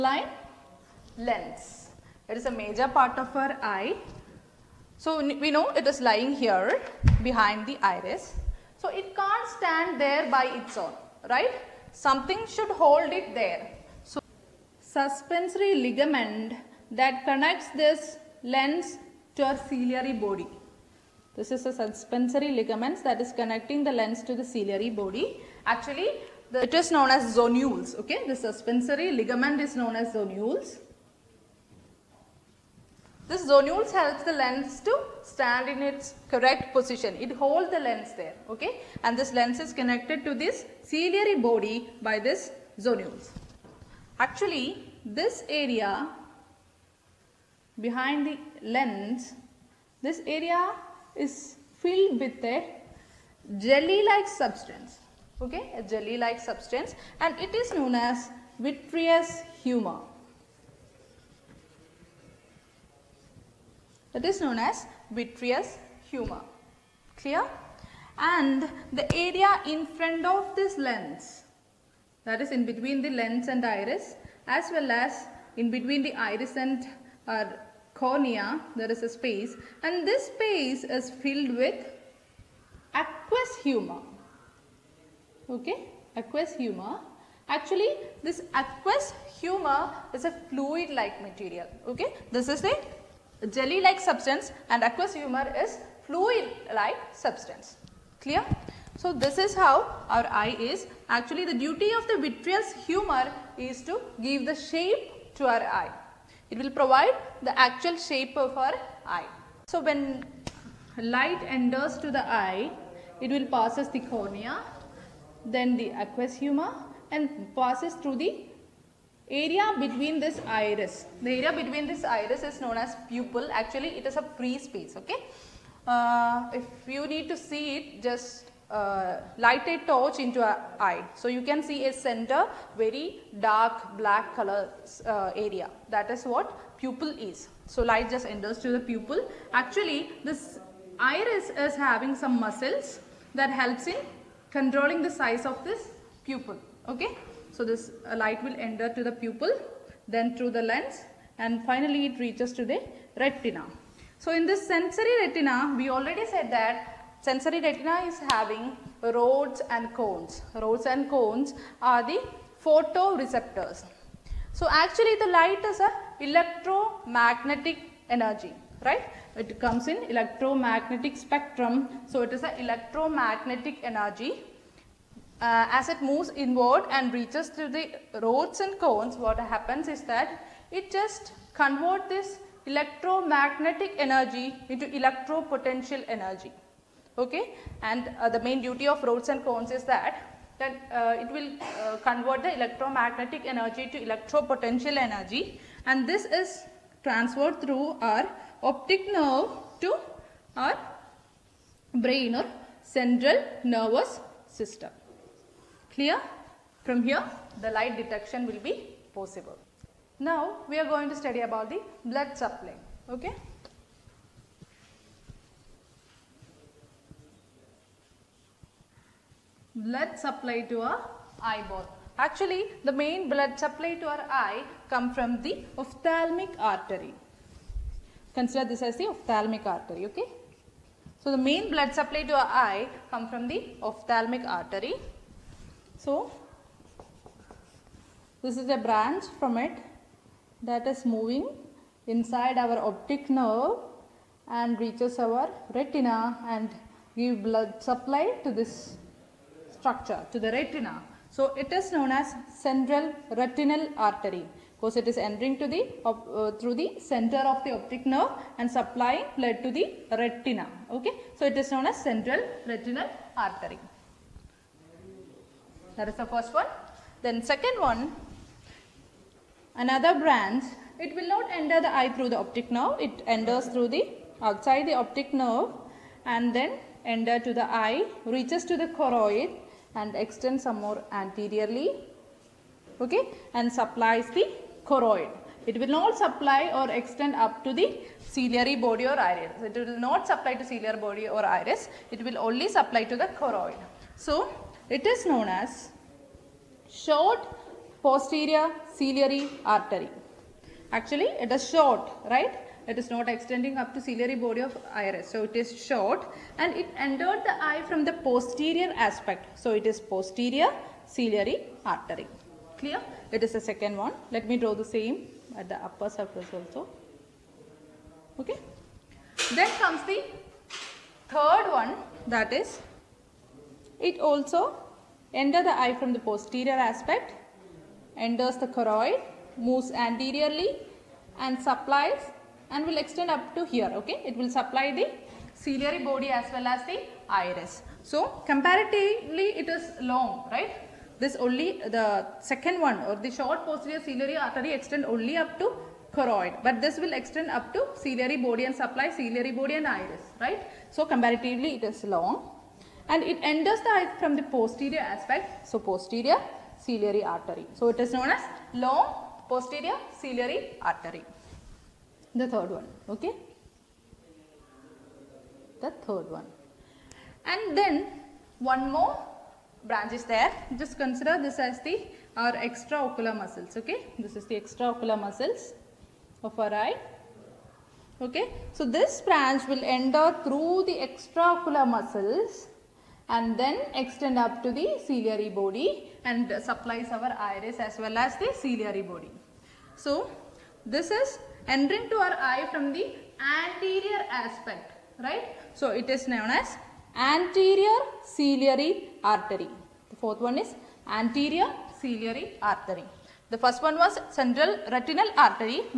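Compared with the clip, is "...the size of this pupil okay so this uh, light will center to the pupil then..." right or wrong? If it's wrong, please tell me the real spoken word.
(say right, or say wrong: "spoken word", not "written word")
wrong: "enter", not "center".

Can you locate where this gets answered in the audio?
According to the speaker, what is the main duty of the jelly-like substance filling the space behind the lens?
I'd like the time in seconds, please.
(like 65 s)
104 s.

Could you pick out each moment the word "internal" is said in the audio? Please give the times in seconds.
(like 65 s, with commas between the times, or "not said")
not said.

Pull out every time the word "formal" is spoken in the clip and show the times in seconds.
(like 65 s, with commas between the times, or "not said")
not said.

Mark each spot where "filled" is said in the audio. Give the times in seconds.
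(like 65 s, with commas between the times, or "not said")
51 s, 81 s.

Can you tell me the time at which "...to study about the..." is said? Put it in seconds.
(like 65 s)
211 s.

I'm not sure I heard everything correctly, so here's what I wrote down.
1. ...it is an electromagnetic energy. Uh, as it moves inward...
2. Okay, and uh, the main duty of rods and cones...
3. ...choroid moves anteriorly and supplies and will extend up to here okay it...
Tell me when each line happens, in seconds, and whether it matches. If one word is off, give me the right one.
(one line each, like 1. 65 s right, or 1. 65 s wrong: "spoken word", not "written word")
1. 172 s right
2. 187 s right
3. 328 s right.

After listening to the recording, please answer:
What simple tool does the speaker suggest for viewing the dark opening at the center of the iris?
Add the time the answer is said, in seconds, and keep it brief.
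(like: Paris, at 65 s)
A torch, at 129 s.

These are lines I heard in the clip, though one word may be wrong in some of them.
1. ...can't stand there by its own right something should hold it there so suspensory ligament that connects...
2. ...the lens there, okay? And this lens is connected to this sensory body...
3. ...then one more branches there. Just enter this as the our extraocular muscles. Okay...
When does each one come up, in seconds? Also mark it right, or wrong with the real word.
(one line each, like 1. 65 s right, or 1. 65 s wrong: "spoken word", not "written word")
1. 9 s right
2. 37 s wrong: "ciliary", not "sensory"
3. 367 s wrong: "consider", not "enter".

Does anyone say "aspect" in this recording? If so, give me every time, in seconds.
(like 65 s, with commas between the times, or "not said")
308 s, 326 s, 355 s, 394 s.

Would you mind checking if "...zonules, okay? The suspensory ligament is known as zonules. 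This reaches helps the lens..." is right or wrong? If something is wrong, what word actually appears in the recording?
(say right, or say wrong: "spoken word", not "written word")
wrong: "zonules", not "reaches".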